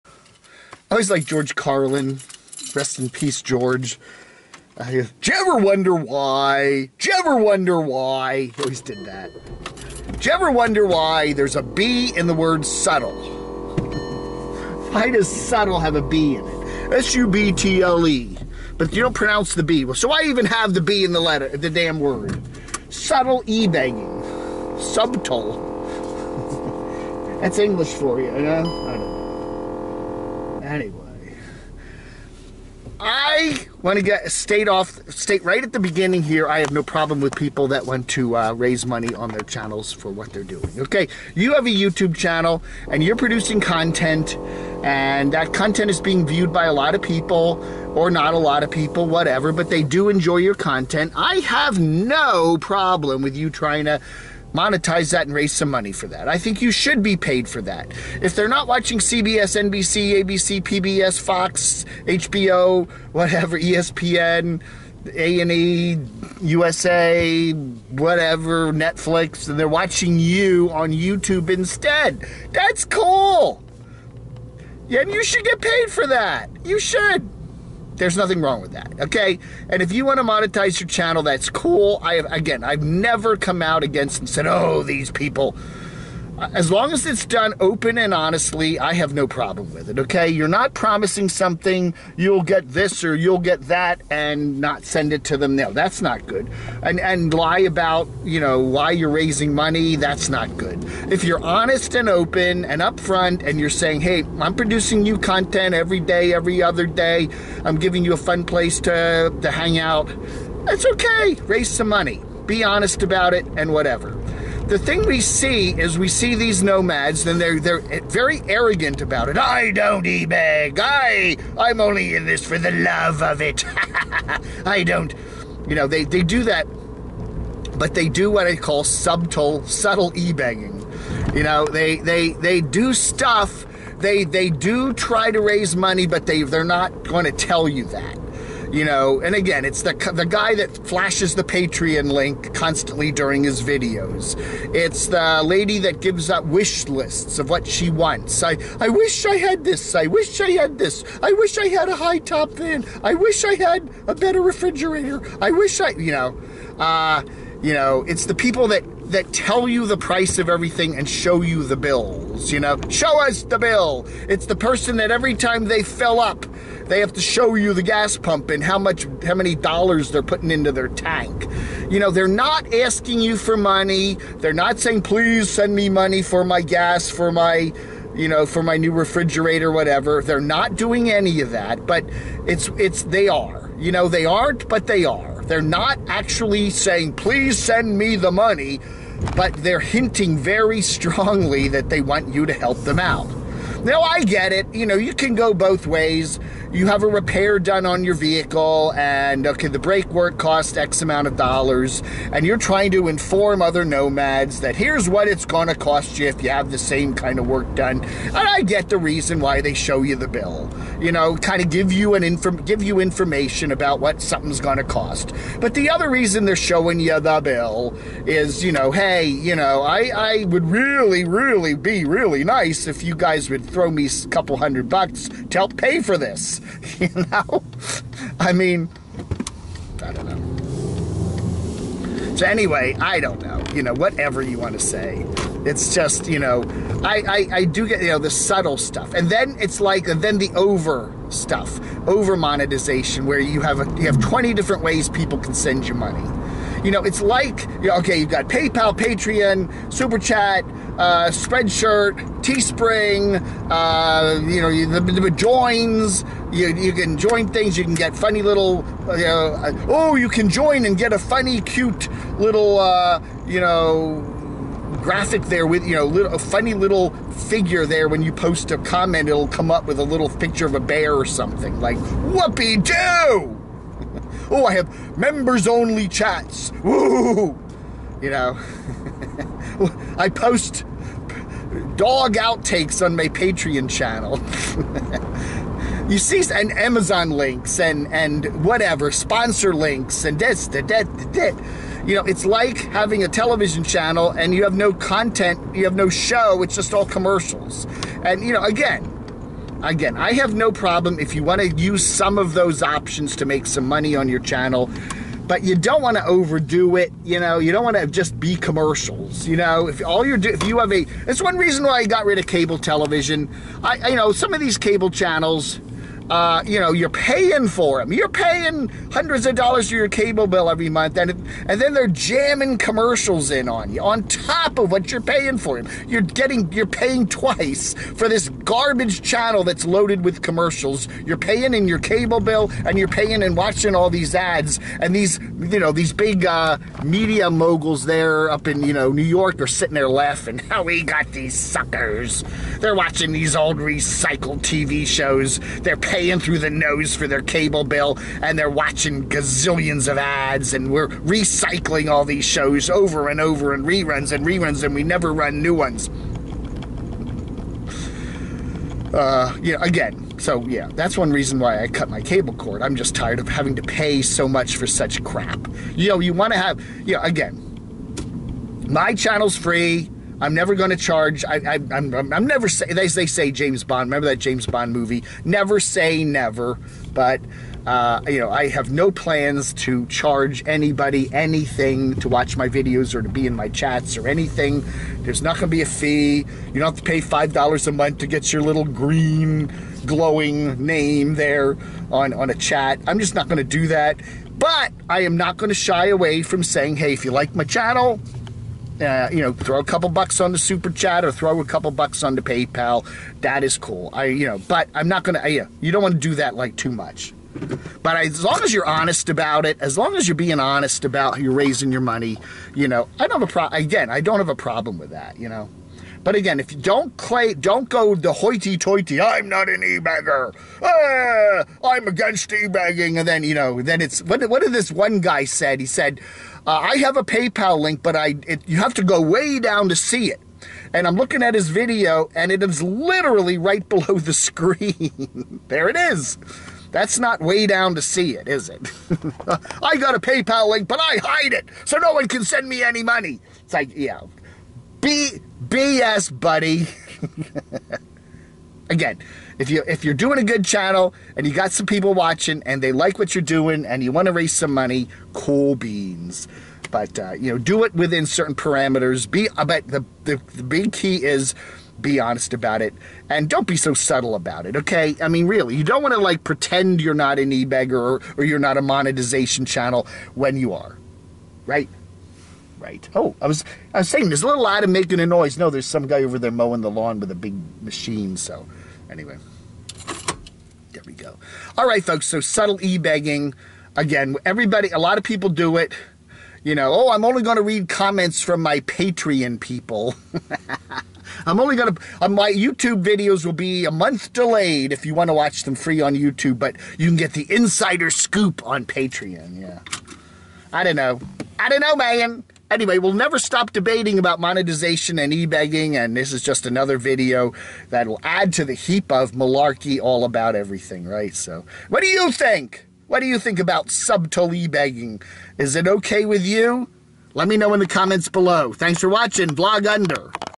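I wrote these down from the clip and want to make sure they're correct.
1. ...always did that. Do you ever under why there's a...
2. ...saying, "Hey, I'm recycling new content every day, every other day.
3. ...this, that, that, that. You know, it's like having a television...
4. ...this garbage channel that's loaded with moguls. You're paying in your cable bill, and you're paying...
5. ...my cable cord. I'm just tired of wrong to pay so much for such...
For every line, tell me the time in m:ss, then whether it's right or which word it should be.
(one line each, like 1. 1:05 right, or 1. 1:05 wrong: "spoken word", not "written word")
1. 0:08 wrong: "wonder", not "under"
2. 1:43 wrong: "producing", not "recycling"
3. 4:50 right
4. 5:28 wrong: "commercials", not "moguls"
5. 6:02 wrong: "having", not "wrong".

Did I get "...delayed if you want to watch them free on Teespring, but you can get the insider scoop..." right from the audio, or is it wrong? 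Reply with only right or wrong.
wrong.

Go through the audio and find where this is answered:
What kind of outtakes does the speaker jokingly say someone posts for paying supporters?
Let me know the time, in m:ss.
4:41.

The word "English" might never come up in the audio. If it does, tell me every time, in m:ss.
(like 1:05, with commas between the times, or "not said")
0:27.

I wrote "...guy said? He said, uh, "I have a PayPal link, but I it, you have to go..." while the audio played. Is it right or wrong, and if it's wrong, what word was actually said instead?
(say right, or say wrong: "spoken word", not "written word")
right.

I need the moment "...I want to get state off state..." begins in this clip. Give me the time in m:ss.
0:32.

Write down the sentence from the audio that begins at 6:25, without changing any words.
There's not going to be a fee.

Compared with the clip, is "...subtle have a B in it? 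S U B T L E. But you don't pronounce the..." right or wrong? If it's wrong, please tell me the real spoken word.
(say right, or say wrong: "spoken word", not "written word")
right.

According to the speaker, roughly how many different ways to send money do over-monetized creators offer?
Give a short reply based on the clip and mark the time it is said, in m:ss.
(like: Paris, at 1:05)
20, at 4:04.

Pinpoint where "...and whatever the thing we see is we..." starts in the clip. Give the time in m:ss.
1:53.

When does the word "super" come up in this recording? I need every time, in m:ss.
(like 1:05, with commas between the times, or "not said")
4:09, 6:40.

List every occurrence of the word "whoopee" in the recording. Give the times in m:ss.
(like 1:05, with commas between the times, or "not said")
4:32.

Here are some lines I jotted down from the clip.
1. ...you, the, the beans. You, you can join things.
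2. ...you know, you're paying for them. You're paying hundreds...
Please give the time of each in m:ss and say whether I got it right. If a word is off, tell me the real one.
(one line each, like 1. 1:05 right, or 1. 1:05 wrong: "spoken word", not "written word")
1. 4:14 wrong: "joins", not "beans"
2. 5:16 right.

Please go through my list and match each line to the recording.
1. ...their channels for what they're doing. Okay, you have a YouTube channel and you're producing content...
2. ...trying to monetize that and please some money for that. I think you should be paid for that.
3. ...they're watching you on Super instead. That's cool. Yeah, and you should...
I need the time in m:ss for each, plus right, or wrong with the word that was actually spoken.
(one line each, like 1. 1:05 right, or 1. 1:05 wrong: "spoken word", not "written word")
1. 0:39 right
2. 0:53 wrong: "raise", not "please"
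3. 1:09 wrong: "YouTube", not "Super".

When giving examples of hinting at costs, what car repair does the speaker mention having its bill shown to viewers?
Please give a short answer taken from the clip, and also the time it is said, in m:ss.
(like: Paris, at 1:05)
brake work, at 3:19.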